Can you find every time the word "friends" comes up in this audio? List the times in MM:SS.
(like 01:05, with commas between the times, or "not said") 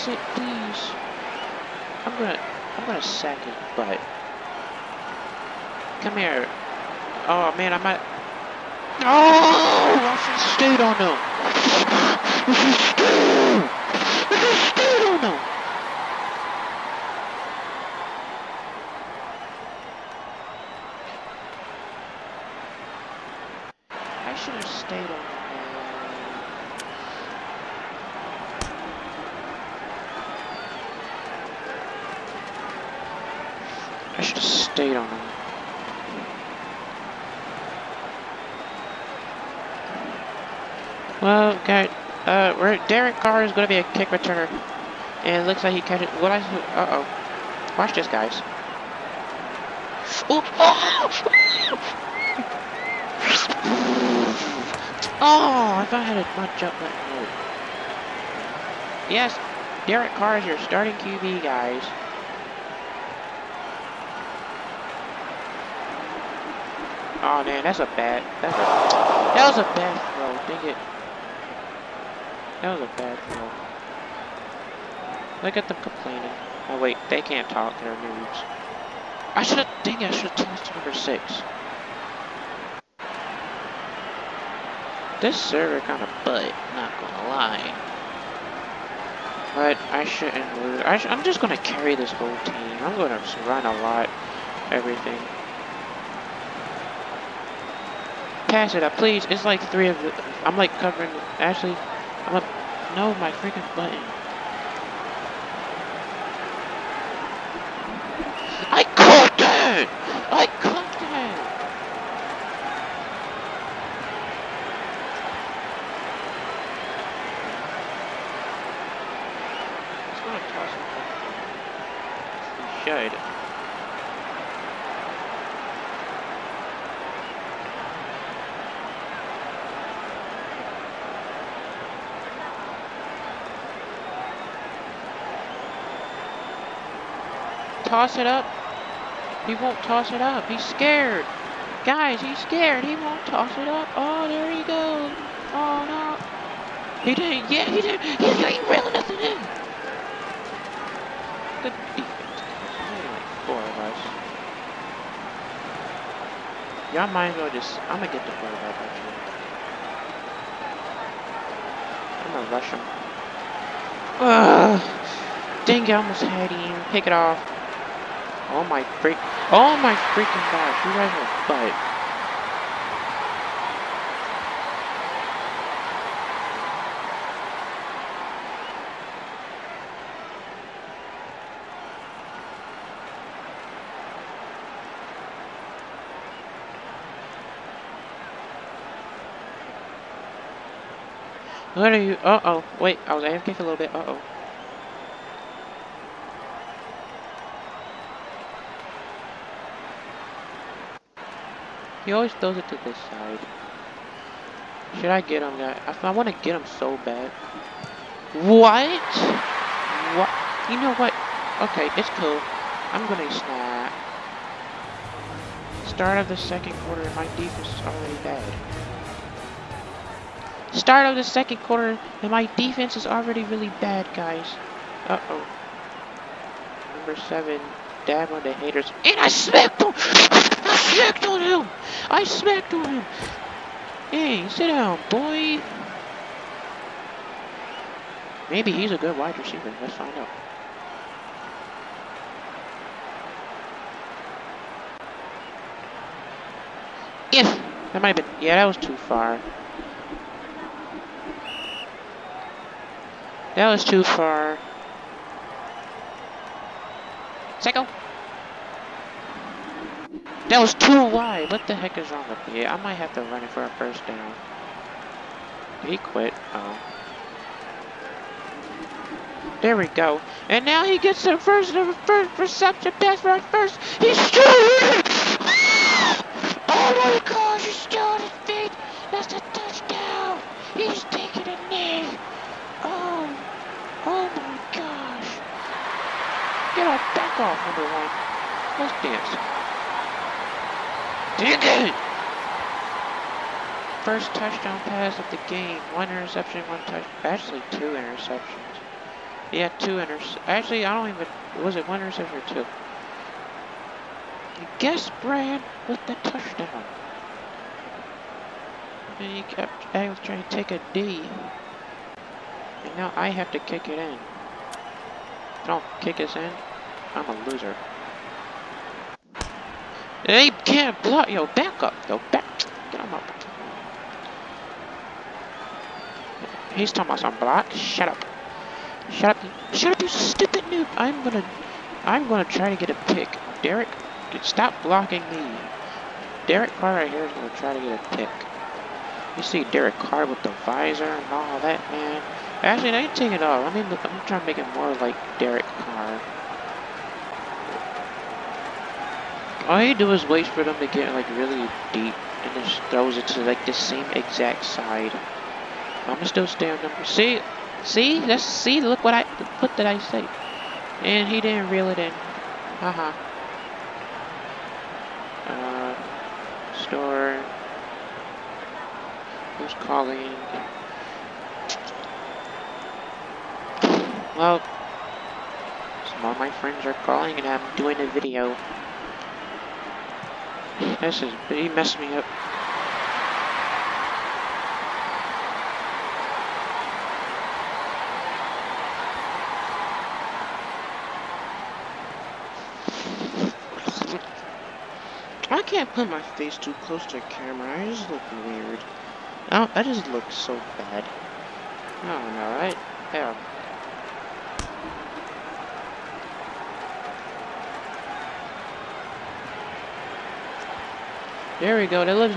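06:16.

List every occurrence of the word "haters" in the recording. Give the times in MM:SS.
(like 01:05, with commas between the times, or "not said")
03:48.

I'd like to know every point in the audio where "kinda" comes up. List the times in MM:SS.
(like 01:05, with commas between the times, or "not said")
01:25.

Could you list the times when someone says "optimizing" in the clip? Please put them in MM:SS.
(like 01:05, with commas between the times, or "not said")
not said.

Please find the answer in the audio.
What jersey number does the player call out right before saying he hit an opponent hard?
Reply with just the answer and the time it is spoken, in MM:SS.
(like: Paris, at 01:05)
7, at 03:46.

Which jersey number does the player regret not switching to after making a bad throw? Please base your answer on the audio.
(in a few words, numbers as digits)
6.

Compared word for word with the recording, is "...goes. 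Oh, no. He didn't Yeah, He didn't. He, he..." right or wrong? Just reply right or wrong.
right.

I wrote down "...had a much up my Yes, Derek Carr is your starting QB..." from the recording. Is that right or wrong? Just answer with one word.
right.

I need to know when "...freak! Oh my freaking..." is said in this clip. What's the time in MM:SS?
02:48.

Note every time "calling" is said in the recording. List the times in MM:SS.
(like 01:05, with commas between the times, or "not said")
06:09, 06:16.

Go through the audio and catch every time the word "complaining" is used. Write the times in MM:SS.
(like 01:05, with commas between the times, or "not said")
01:15.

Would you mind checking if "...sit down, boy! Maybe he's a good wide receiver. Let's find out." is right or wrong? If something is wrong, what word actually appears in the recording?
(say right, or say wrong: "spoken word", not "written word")
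right.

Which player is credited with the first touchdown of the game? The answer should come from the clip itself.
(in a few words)
Brad.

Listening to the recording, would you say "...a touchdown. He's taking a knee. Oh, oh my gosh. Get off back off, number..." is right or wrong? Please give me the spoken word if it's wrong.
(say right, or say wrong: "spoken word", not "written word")
right.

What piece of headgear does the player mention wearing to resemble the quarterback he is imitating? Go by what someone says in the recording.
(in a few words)
visor.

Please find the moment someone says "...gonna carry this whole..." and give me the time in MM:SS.
01:31.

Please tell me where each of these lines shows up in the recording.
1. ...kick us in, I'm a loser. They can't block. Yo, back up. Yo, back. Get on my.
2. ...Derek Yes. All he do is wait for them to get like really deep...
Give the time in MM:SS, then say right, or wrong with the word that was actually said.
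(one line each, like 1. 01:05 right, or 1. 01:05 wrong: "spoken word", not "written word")
1. 05:16 right
2. 05:45 wrong: "Carr", not "Yes".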